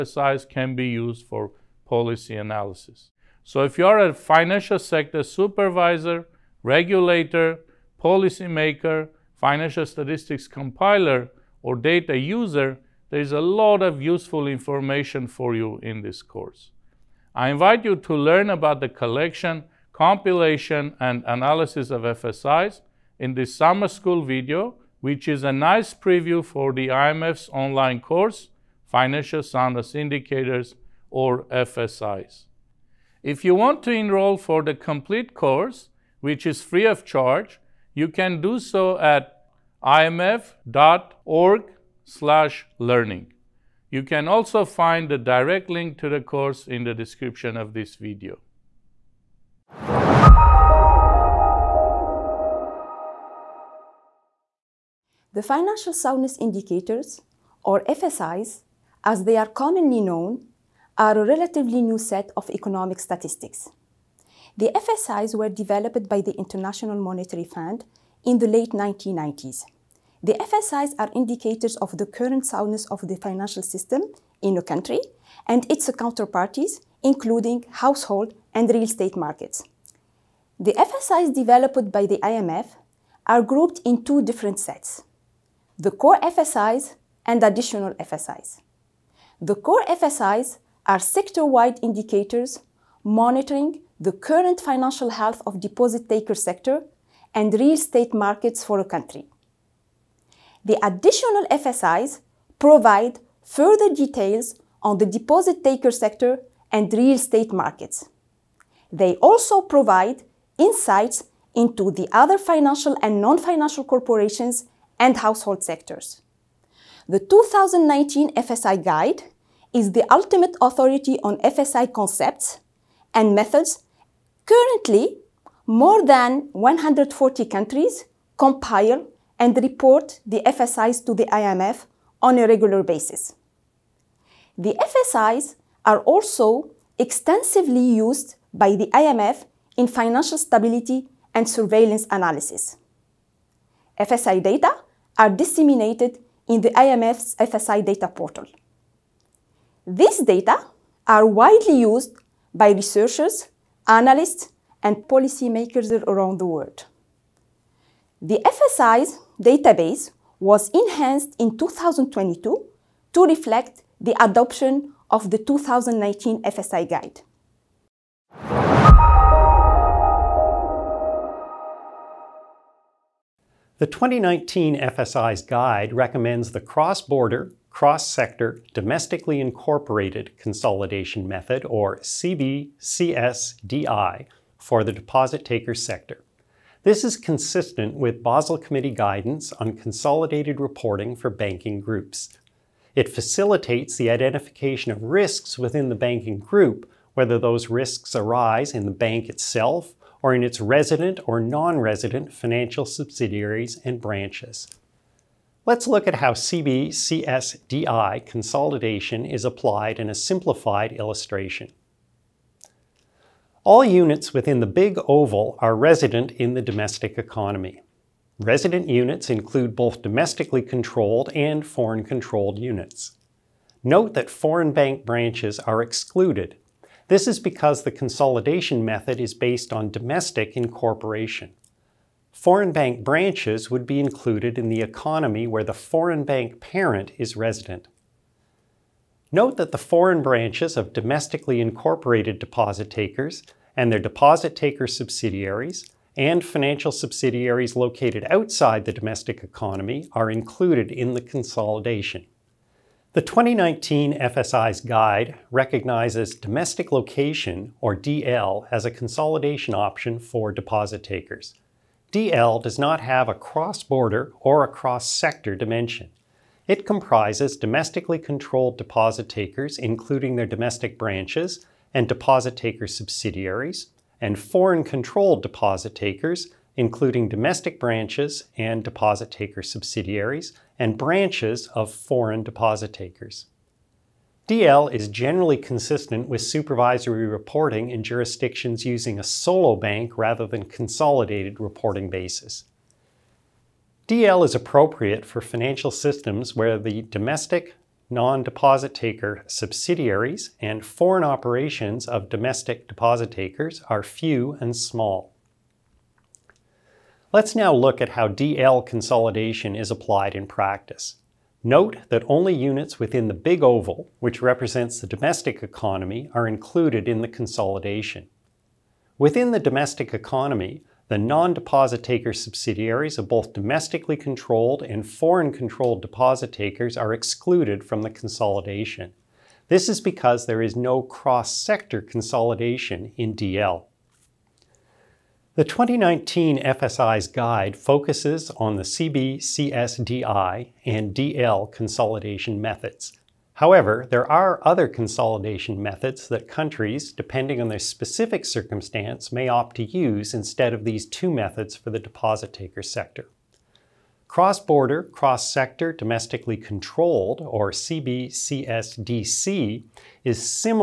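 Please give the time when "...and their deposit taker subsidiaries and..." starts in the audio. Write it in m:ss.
4:03.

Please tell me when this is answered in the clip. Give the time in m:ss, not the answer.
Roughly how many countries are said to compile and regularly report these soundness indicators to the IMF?
2:05.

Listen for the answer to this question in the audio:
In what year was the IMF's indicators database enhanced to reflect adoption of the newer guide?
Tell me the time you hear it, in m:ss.
2:41.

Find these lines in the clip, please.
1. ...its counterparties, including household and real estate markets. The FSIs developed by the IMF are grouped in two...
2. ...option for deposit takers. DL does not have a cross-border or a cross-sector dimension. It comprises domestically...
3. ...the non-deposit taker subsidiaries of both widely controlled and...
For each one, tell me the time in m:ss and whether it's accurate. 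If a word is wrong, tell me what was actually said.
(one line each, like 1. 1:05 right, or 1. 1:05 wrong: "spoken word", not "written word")
1. 1:15 right
2. 4:19 right
3. 5:21 wrong: "domestically", not "widely".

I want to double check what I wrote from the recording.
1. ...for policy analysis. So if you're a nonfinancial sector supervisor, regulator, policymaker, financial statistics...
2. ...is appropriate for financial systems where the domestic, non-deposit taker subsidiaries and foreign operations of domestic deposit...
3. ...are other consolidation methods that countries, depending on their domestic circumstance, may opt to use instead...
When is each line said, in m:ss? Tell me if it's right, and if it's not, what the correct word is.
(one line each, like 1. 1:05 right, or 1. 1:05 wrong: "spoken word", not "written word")
1. 0:01 wrong: "financial", not "nonfinancial"
2. 4:54 right
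3. 5:44 wrong: "specific", not "domestic".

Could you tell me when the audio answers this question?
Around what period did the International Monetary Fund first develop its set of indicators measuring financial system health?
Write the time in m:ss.
1:08.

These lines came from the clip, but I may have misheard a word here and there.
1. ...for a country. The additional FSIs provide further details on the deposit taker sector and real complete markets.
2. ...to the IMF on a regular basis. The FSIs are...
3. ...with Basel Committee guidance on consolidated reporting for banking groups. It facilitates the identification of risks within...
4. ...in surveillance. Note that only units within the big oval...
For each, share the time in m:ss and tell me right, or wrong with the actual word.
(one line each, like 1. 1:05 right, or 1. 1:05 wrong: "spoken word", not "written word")
1. 1:38 wrong: "estate", not "complete"
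2. 2:11 right
3. 3:07 right
4. 5:10 wrong: "practice", not "surveillance".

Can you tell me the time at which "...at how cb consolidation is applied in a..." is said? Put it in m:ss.
3:26.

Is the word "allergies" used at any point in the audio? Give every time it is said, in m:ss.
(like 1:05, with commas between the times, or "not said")
not said.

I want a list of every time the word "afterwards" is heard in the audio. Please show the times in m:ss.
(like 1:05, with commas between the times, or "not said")
not said.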